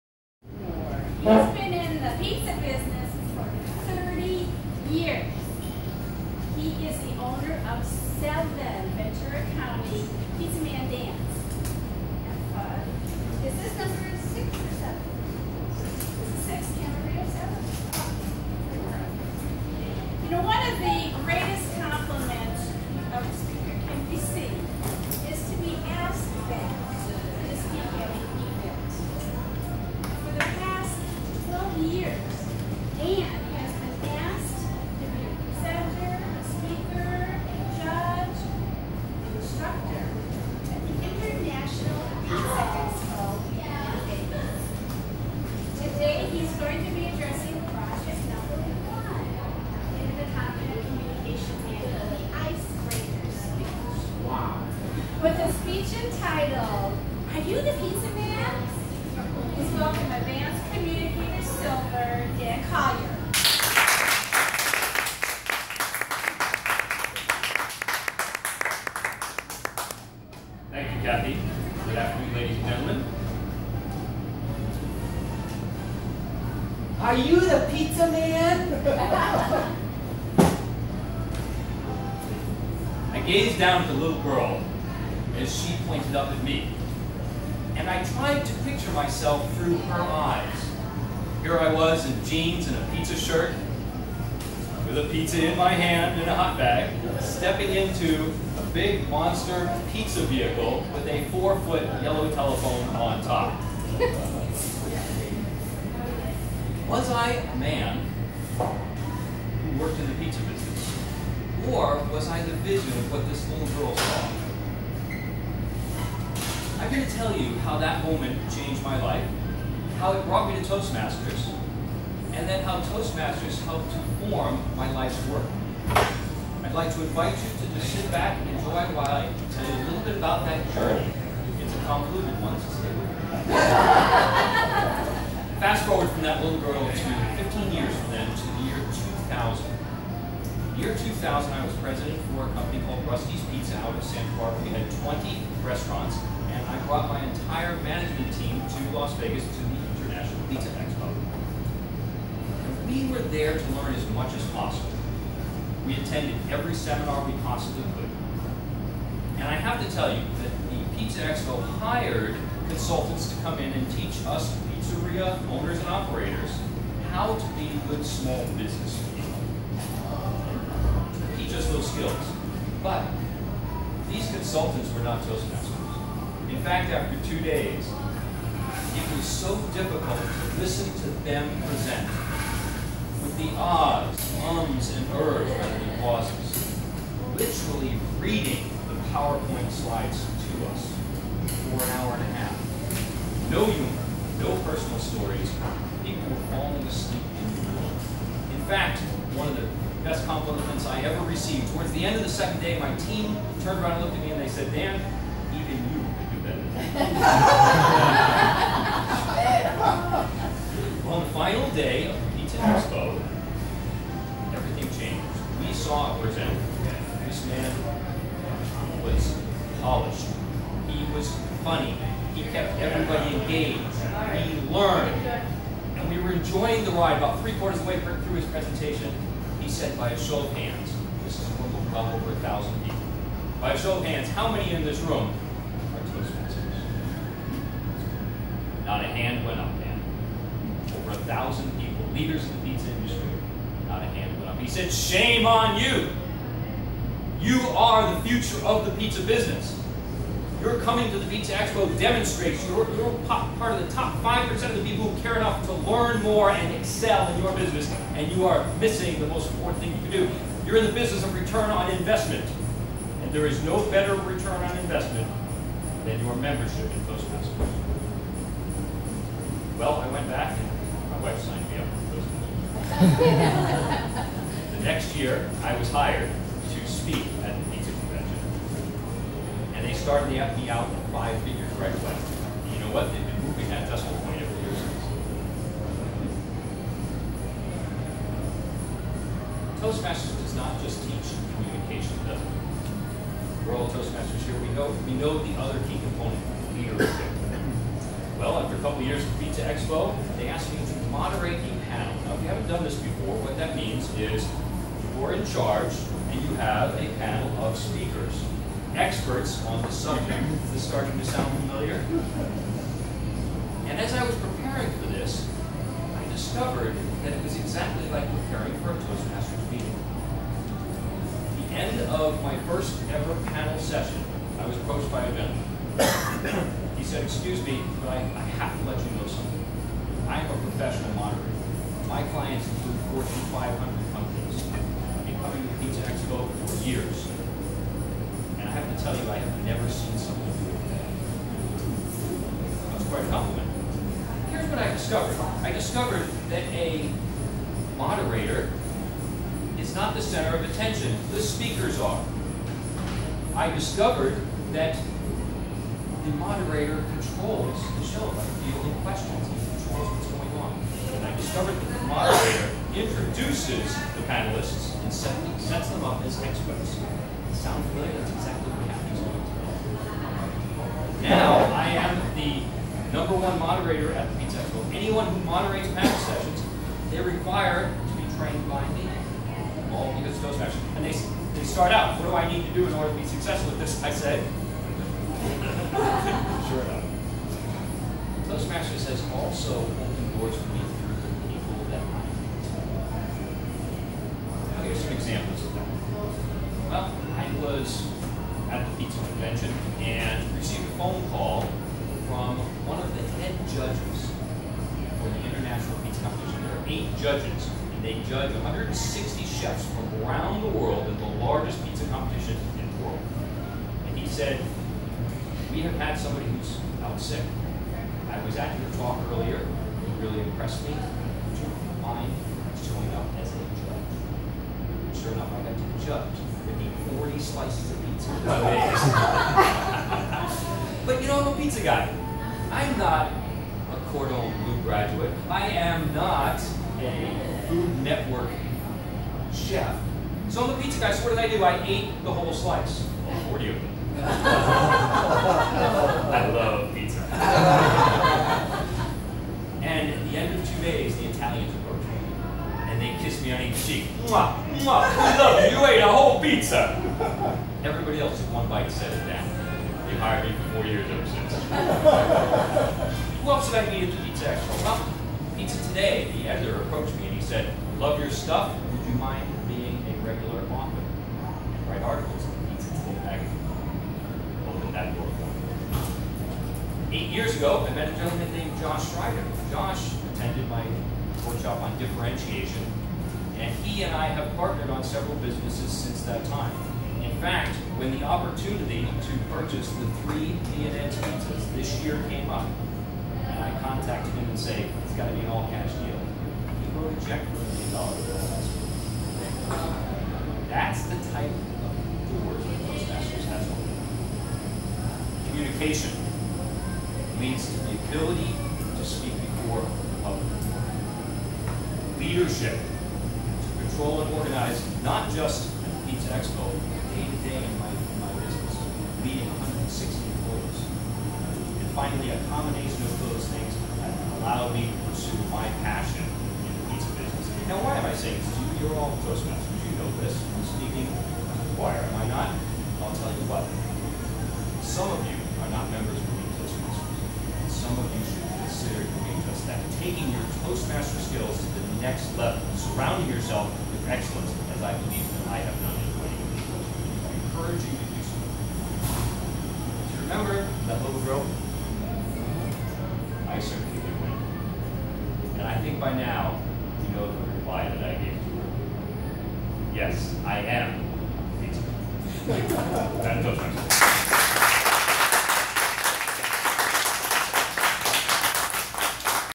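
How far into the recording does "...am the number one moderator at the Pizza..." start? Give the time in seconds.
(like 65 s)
371 s.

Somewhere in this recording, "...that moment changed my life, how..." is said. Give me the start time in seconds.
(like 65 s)
117 s.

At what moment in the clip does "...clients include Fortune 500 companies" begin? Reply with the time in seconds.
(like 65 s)
332 s.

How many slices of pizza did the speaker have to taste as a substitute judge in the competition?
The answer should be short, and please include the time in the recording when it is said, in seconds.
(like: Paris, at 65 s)
40, at 427 s.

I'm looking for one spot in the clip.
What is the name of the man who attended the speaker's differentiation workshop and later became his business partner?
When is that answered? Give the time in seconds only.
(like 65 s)
478 s.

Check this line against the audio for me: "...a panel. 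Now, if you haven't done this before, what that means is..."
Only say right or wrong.
right.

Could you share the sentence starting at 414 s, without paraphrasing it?
And he said, we have had somebody who's out sick.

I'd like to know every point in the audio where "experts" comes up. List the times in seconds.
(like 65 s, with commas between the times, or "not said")
308 s, 366 s.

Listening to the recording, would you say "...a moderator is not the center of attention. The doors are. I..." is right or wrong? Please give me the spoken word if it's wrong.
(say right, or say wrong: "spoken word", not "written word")
wrong: "speakers", not "doors".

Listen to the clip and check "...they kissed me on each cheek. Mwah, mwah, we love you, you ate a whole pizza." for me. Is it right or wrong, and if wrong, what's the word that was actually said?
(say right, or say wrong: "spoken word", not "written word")
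right.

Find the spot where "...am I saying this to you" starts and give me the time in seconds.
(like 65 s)
527 s.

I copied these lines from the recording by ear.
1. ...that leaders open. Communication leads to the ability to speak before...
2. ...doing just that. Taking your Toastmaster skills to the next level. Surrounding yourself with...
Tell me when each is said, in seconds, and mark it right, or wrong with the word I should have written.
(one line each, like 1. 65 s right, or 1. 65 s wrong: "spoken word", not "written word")
1. 502 s wrong: "masters", not "leaders"
2. 539 s right.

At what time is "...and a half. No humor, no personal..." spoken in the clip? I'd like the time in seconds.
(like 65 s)
192 s.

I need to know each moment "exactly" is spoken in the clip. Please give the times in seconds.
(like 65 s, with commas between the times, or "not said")
317 s, 368 s.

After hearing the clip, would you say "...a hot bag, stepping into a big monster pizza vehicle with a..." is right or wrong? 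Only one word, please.
right.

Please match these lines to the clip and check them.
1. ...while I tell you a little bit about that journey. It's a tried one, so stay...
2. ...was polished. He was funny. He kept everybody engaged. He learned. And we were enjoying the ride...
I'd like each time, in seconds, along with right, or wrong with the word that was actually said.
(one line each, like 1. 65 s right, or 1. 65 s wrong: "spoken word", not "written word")
1. 128 s wrong: "convoluted", not "tried"
2. 219 s right.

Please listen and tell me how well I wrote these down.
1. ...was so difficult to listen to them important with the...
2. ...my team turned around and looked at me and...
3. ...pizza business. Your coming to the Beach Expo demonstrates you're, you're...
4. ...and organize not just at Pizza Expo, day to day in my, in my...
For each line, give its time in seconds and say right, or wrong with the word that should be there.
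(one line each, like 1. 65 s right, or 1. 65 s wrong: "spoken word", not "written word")
1. 179 s wrong: "present", not "important"
2. 202 s right
3. 248 s right
4. 514 s right.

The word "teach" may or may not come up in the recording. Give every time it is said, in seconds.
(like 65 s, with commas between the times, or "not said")
163 s, 291 s.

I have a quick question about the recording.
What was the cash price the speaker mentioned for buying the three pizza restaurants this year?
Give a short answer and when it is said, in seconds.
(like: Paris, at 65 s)
a million dollars, at 497 s.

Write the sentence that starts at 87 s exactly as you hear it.
And I tried to picture myself through her eyes.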